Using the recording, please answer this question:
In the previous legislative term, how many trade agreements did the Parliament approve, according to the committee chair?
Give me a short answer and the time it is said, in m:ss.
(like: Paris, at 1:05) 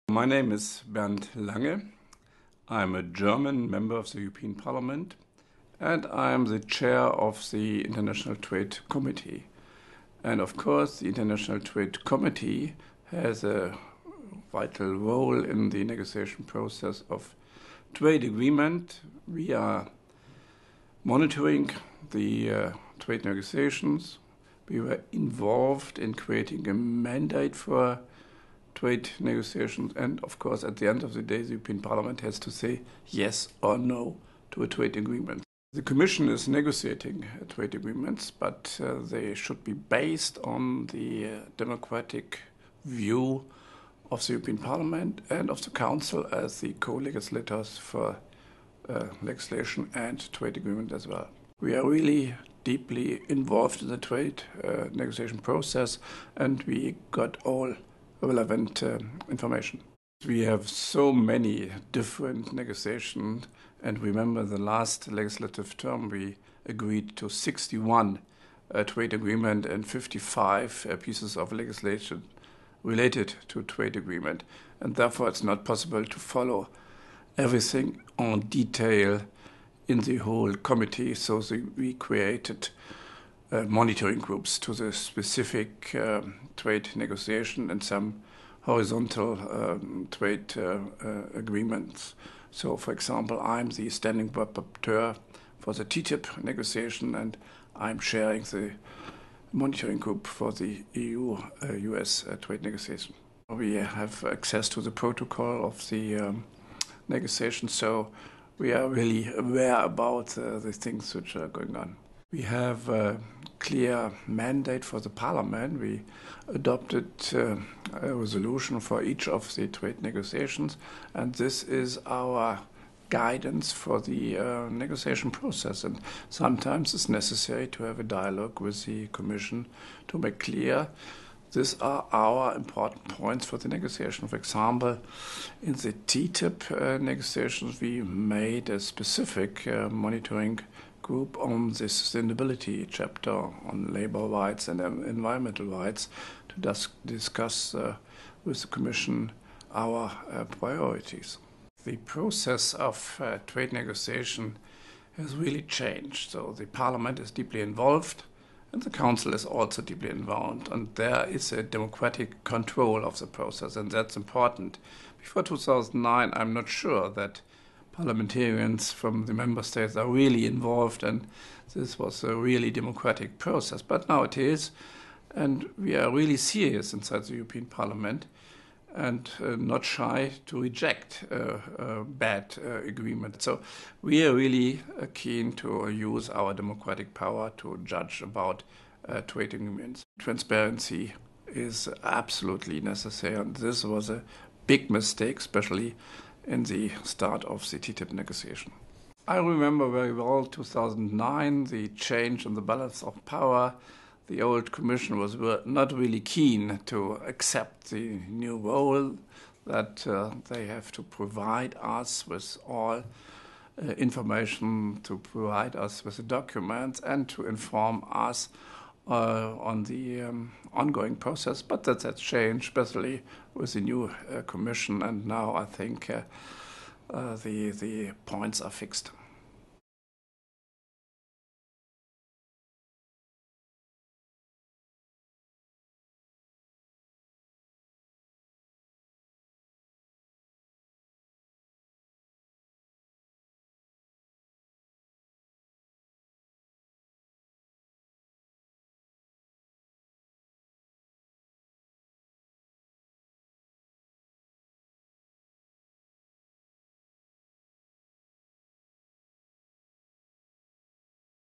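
61, at 1:07.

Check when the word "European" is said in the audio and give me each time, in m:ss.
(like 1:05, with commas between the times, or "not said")
0:04, 0:31, 0:44, 2:57.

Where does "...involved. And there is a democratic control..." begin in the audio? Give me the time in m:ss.
2:40.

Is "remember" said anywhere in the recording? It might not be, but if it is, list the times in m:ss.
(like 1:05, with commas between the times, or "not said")
1:03, 3:19.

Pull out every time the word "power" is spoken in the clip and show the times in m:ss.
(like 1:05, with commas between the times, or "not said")
3:07, 3:23.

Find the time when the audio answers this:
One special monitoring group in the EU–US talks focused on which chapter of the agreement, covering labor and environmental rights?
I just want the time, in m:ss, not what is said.
2:22.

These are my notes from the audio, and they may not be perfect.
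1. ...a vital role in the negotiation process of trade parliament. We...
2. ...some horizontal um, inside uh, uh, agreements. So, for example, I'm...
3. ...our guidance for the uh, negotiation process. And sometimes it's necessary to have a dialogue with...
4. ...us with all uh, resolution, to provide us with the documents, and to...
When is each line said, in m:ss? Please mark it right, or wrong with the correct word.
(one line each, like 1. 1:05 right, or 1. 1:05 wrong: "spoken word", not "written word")
1. 0:13 wrong: "agreement", not "parliament"
2. 1:27 wrong: "trade", not "inside"
3. 2:02 right
4. 3:31 wrong: "information", not "resolution".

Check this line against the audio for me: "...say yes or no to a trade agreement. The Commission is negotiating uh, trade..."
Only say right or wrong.
right.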